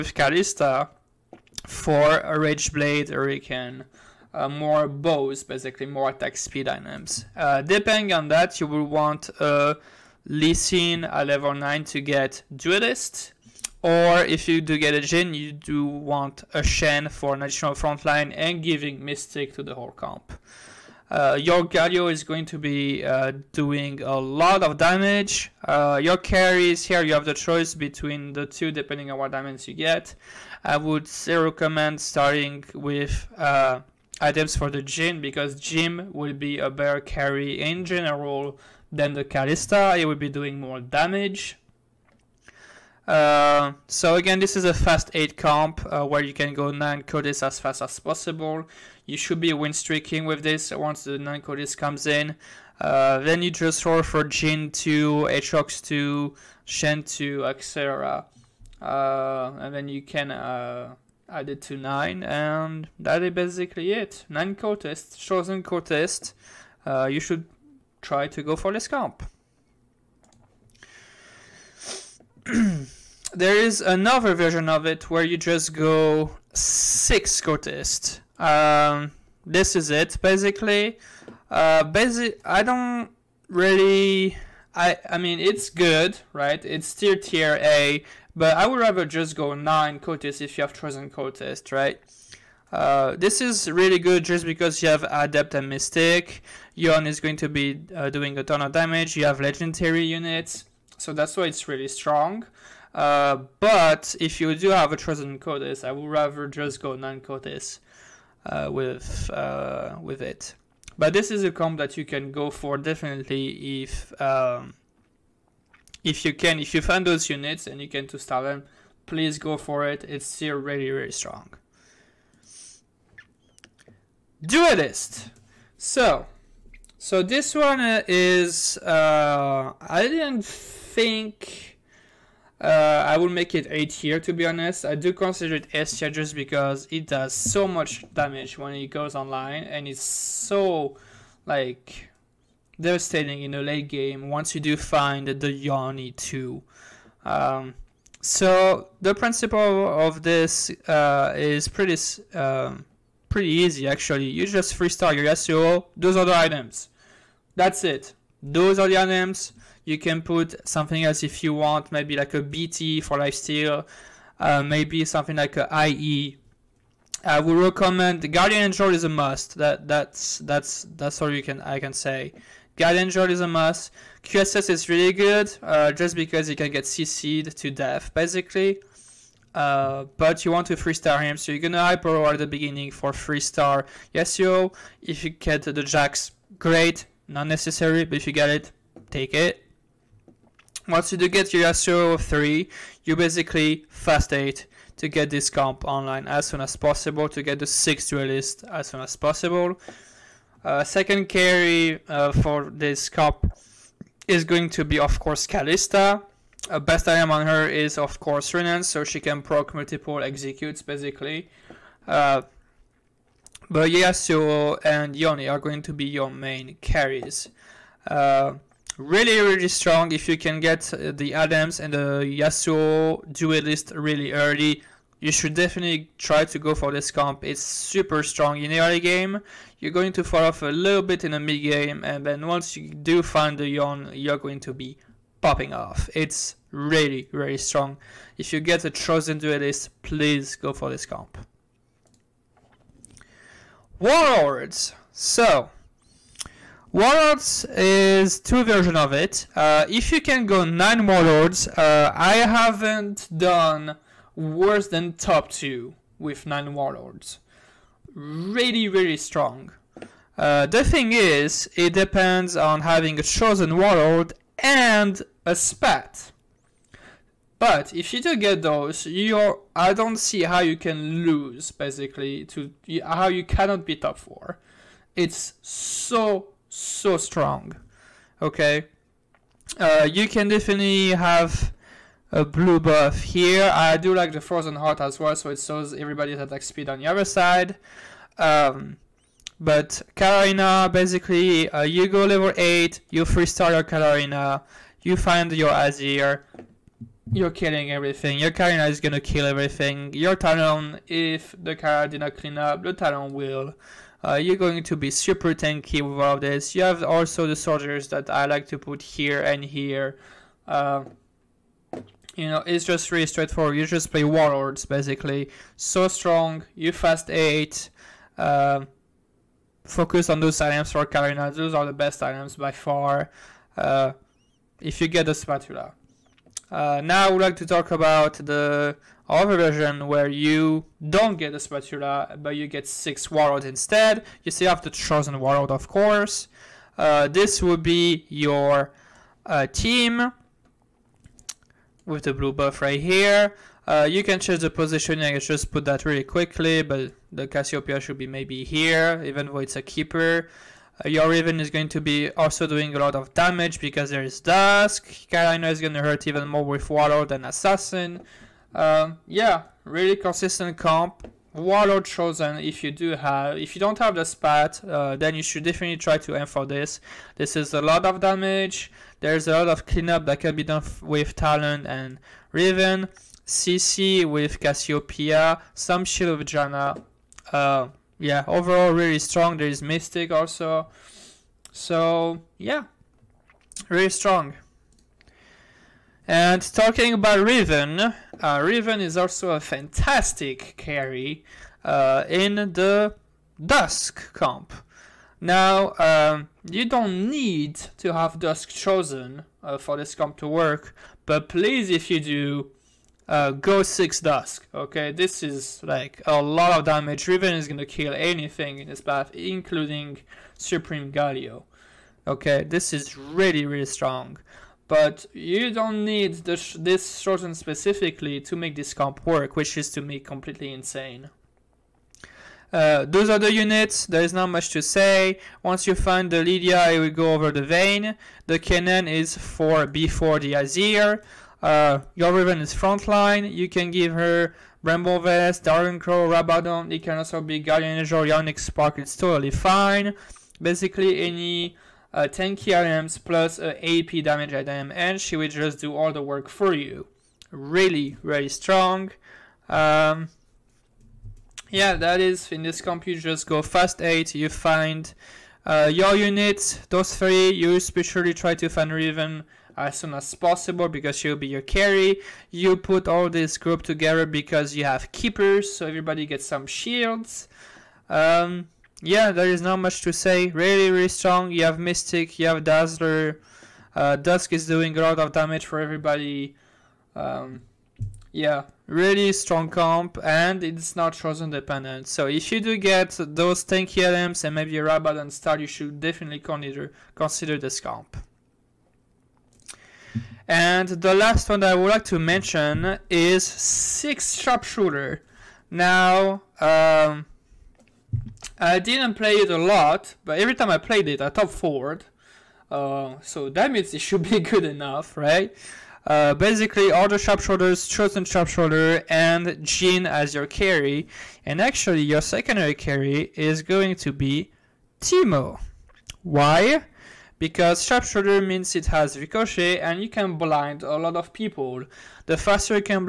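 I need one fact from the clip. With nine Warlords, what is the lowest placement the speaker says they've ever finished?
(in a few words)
top 2.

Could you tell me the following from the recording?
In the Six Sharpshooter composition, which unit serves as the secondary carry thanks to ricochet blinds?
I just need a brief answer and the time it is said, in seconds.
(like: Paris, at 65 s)
Teemo, at 512 s.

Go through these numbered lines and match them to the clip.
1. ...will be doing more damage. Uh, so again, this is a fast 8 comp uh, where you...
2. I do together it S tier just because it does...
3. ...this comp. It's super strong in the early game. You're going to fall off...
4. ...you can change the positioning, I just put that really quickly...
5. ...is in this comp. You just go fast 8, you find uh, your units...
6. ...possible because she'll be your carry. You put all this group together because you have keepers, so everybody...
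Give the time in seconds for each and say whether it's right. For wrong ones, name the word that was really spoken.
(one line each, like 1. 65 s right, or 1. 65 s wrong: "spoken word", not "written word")
1. 40 s right
2. 134 s wrong: "consider", not "together"
3. 226 s right
4. 344 s right
5. 452 s right
6. 460 s right.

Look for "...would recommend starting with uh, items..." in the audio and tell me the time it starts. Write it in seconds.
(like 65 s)
30 s.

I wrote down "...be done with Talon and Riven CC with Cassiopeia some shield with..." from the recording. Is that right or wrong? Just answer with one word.
right.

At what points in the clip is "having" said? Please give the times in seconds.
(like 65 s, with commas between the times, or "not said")
262 s.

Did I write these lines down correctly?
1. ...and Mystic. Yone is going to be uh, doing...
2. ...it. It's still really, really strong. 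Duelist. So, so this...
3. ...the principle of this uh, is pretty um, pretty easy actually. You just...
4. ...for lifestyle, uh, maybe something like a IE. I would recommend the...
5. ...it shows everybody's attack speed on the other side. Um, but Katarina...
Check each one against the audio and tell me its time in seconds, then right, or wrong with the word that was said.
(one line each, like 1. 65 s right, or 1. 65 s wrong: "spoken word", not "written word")
1. 95 s right
2. 119 s right
3. 149 s right
4. 163 s right
5. 285 s right.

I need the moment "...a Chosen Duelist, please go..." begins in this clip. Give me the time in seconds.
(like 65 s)
238 s.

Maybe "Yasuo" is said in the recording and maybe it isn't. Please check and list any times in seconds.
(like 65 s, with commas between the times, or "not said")
184 s, 191 s, 213 s, 222 s.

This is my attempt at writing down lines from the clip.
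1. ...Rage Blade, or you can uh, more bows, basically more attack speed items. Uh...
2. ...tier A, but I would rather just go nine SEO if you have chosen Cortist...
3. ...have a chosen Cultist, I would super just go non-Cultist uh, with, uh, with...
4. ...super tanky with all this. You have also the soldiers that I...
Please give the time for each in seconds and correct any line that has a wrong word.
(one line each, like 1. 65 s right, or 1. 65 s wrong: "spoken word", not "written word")
1. 2 s right
2. 87 s wrong: "Cortist", not "SEO"
3. 104 s wrong: "rather", not "super"
4. 305 s right.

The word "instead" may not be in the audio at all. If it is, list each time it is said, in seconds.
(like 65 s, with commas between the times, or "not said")
333 s.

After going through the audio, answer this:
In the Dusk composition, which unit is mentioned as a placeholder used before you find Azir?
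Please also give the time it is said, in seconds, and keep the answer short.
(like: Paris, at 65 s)
Kennen, at 428 s.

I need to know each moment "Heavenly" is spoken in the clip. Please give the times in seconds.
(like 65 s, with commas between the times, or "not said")
not said.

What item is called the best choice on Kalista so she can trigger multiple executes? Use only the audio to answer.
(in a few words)
Runaan.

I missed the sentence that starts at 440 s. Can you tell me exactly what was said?
Basically, any uh, 10 items plus uh, AP damage item, and she will just do all the work for you.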